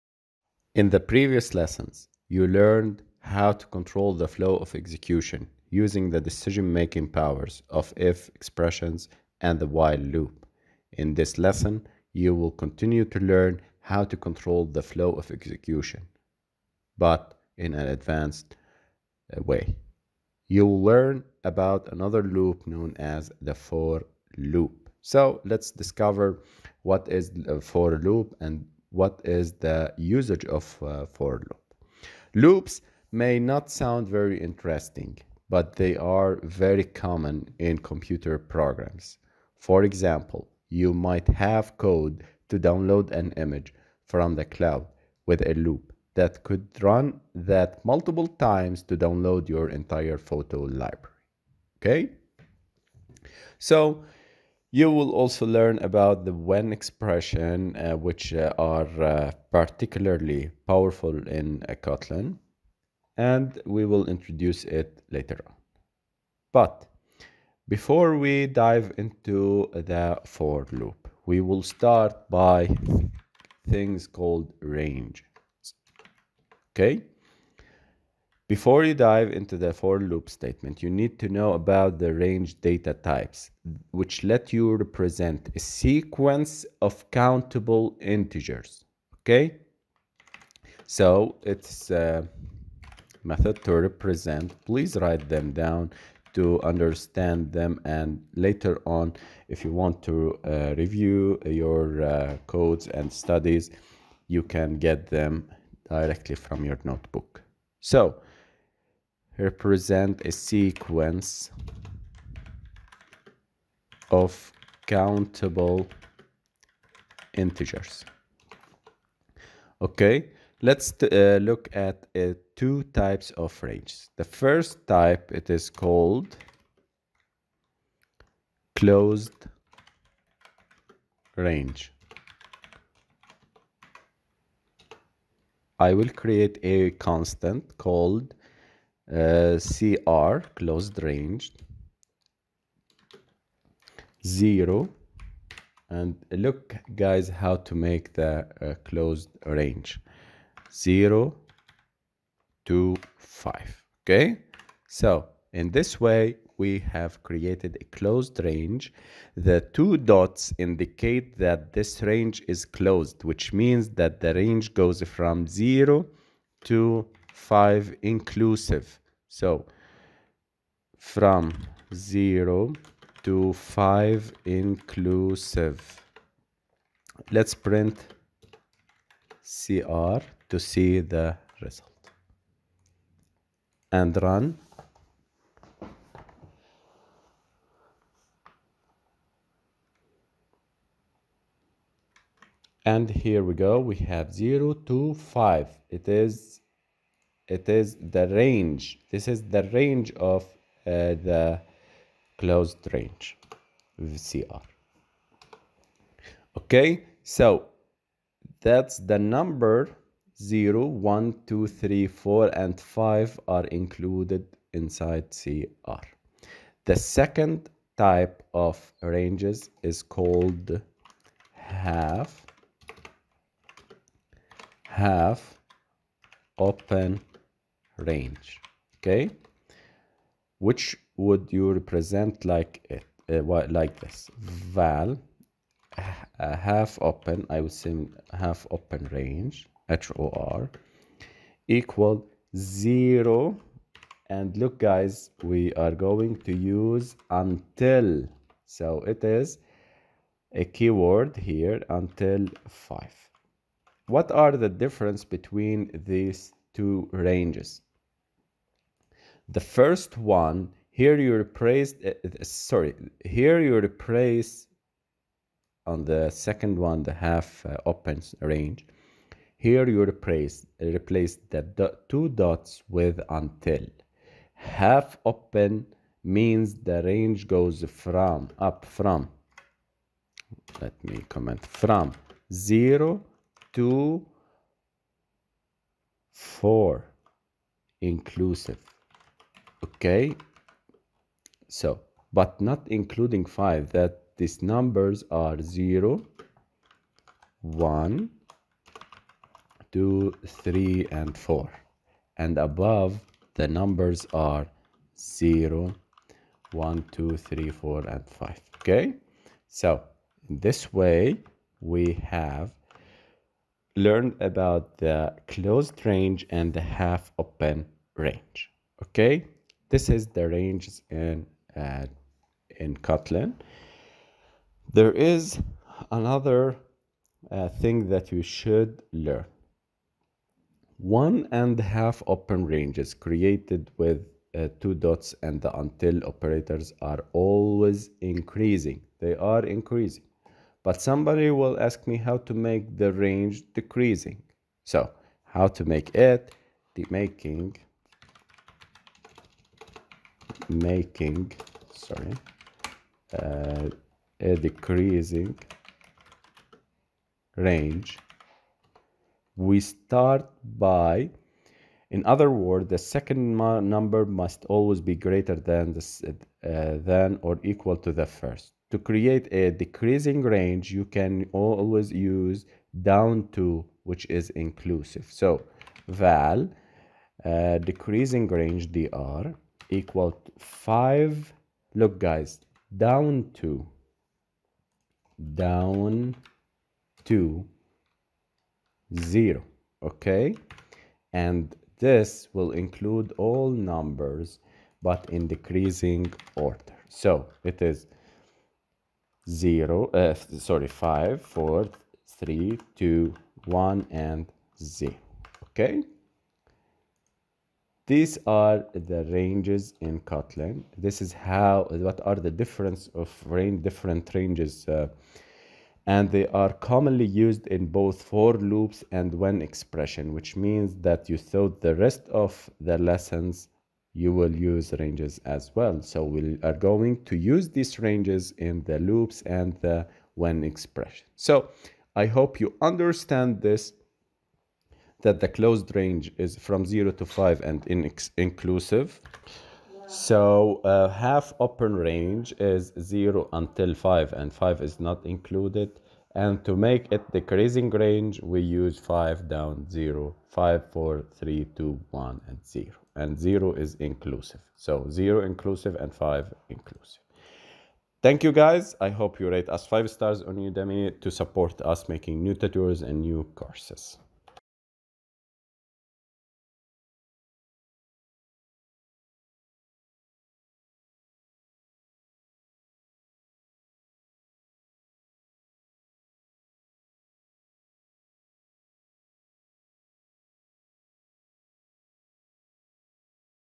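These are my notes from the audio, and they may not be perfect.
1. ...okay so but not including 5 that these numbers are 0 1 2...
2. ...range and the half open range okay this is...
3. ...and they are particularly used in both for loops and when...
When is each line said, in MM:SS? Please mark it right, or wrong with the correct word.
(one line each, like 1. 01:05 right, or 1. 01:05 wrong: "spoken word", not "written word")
1. 04:49 right
2. 05:16 right
3. 06:56 wrong: "commonly", not "particularly".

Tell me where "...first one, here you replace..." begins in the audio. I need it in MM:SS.
04:19.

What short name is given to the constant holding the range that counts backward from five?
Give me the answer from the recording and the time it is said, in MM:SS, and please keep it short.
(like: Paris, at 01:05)
DR, at 06:18.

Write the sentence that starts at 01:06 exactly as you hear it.
But before we dive into the for loop, we will start by things called range.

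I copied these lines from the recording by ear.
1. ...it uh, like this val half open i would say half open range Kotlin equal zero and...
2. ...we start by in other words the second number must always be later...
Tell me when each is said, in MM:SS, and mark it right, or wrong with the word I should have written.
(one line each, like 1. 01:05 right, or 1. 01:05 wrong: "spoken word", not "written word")
1. 03:52 wrong: "HOR", not "Kotlin"
2. 05:59 wrong: "greater", not "later".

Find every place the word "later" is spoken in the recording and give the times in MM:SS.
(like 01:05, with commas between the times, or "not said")
01:05, 01:38.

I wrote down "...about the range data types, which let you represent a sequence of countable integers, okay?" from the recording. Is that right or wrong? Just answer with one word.
right.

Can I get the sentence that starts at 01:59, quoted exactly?
Okay, let's uh, look at uh, two types of ranges.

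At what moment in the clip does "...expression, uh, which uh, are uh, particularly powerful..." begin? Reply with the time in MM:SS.
00:56.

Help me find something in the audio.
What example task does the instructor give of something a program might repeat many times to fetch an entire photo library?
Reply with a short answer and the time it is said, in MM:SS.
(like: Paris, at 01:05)
Download an image from the cloud, at 00:42.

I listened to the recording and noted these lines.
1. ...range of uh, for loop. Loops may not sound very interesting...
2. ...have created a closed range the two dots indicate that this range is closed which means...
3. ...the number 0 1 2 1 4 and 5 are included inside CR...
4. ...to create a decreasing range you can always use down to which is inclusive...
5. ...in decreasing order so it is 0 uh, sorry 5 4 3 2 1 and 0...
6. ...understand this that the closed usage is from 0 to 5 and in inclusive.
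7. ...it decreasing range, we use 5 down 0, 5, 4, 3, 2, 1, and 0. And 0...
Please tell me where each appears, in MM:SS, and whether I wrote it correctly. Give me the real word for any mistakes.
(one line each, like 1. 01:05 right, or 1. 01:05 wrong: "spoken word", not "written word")
1. 00:29 wrong: "usage", not "range"
2. 02:36 right
3. 03:28 wrong: "3", not "1"
4. 06:08 right
5. 06:35 right
6. 07:12 wrong: "range", not "usage"
7. 07:27 right.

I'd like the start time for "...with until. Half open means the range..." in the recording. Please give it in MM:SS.
04:32.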